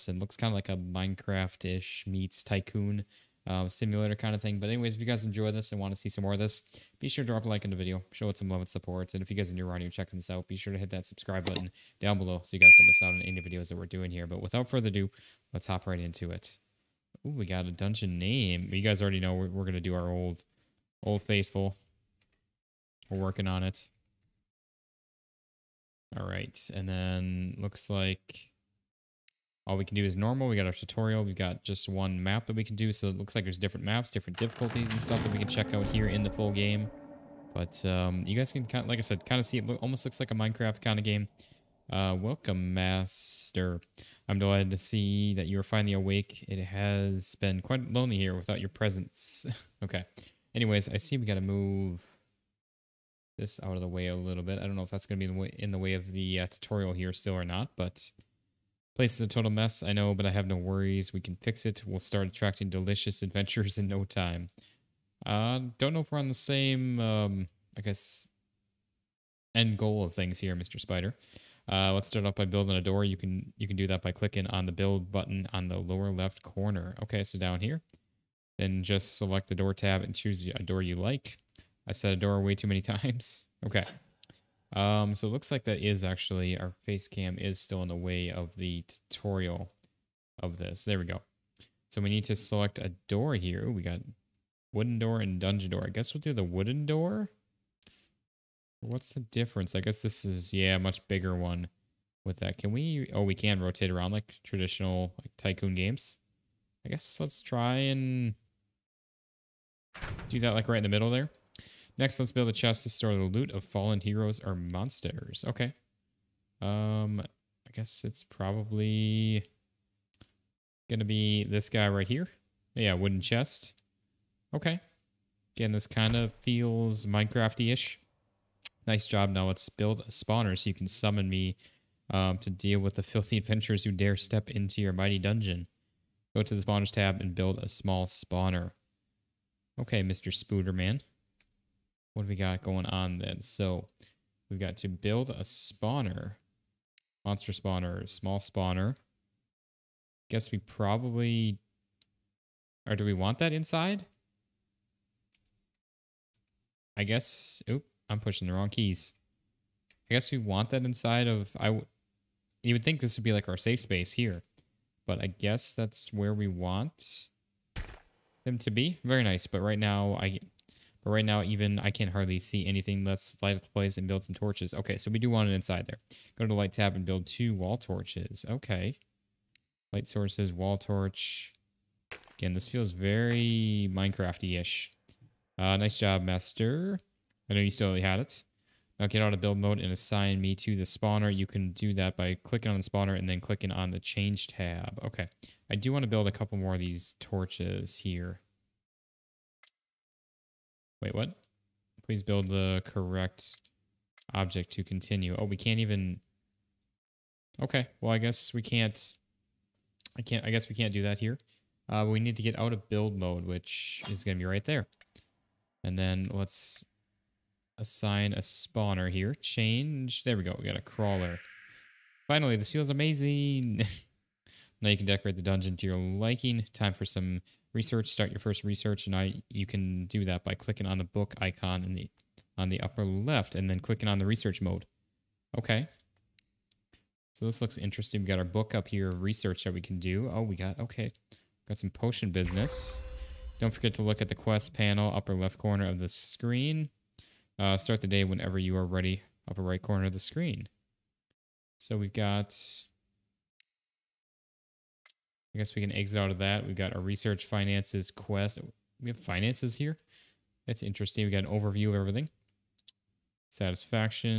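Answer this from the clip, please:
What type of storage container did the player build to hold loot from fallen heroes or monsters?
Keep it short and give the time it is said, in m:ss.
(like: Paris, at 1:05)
Wooden chest, at 2:02.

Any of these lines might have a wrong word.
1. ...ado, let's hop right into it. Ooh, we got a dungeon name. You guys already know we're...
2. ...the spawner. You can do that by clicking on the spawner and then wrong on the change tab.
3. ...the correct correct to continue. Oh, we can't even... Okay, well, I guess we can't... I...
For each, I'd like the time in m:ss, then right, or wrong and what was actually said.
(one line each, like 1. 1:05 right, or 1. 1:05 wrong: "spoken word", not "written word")
1. 0:14 right
2. 3:10 wrong: "clicking", not "wrong"
3. 3:22 wrong: "object", not "correct".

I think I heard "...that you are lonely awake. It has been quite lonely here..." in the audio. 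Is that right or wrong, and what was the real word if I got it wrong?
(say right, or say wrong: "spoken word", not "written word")
wrong: "finally", not "lonely".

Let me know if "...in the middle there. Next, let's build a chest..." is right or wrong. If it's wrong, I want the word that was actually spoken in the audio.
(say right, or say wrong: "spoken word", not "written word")
right.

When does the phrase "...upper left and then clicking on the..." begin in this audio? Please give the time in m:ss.
3:52.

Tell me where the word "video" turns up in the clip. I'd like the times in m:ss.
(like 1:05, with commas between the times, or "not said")
0:07, 0:13.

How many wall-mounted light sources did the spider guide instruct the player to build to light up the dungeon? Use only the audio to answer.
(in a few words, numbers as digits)
2.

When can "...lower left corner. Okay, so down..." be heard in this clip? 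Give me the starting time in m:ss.
1:15.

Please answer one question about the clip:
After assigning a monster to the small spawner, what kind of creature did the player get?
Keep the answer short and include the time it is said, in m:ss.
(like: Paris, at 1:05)
A crawler, at 3:40.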